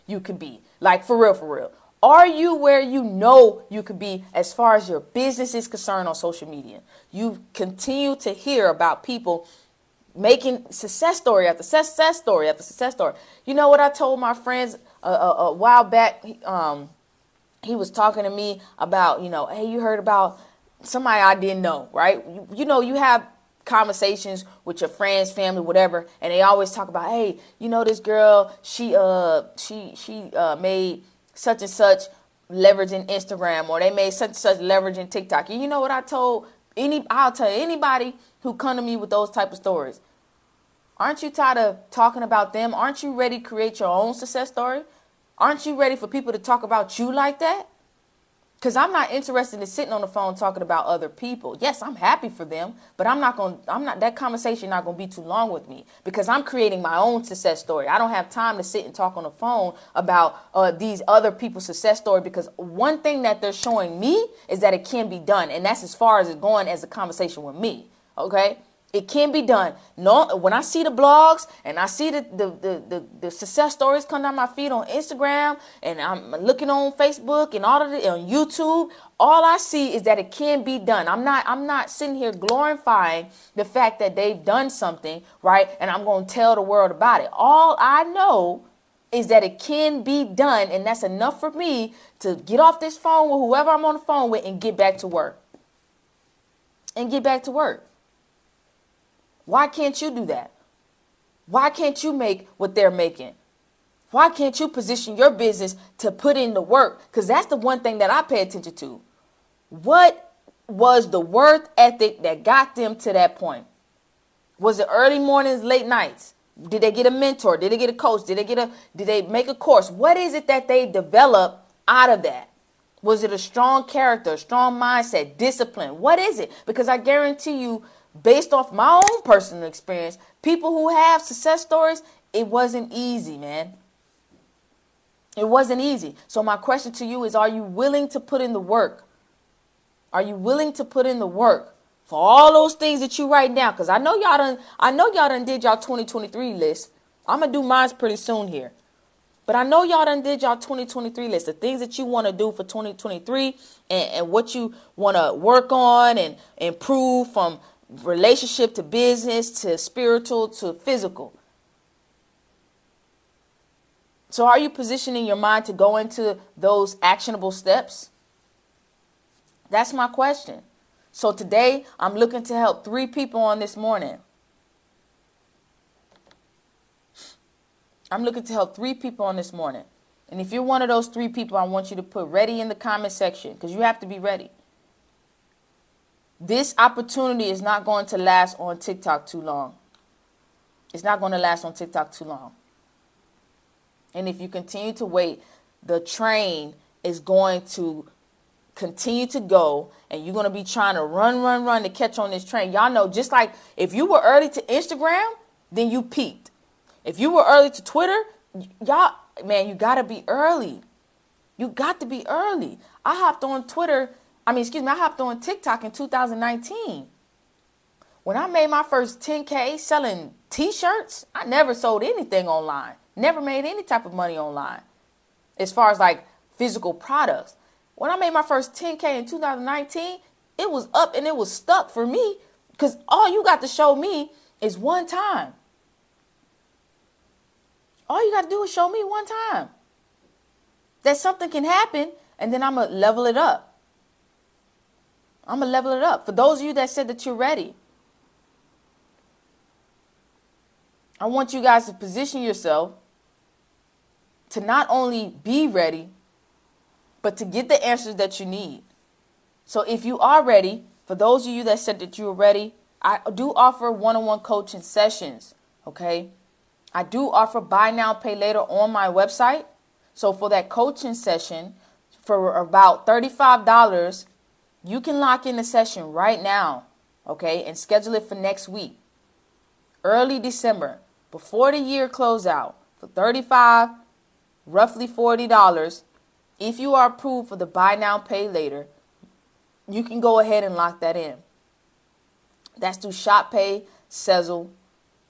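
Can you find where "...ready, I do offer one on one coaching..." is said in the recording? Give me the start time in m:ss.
4:22.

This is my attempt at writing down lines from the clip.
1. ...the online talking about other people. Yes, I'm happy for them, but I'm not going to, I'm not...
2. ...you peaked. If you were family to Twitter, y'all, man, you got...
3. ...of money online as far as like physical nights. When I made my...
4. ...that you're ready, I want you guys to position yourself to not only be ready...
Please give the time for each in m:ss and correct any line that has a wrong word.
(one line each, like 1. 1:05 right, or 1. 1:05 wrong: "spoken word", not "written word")
1. 0:50 wrong: "phone", not "online"
2. 3:25 wrong: "early", not "family"
3. 3:44 wrong: "products", not "nights"
4. 4:07 right.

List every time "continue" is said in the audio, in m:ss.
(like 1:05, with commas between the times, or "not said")
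0:07, 3:14, 3:18.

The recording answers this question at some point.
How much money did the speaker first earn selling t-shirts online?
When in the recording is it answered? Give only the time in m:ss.
3:38.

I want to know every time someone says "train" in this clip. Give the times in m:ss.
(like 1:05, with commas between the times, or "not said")
3:15, 3:22.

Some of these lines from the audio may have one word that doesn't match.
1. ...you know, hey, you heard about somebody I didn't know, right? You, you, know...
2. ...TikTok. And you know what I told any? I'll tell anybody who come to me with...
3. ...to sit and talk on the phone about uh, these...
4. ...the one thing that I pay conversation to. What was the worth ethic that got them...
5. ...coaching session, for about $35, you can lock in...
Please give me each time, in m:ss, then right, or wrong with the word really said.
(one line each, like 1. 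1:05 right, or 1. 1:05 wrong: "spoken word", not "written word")
1. 0:19 right
2. 0:35 right
3. 0:58 right
4. 1:47 wrong: "attention", not "conversation"
5. 4:30 right.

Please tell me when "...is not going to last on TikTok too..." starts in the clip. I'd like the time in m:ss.
3:07.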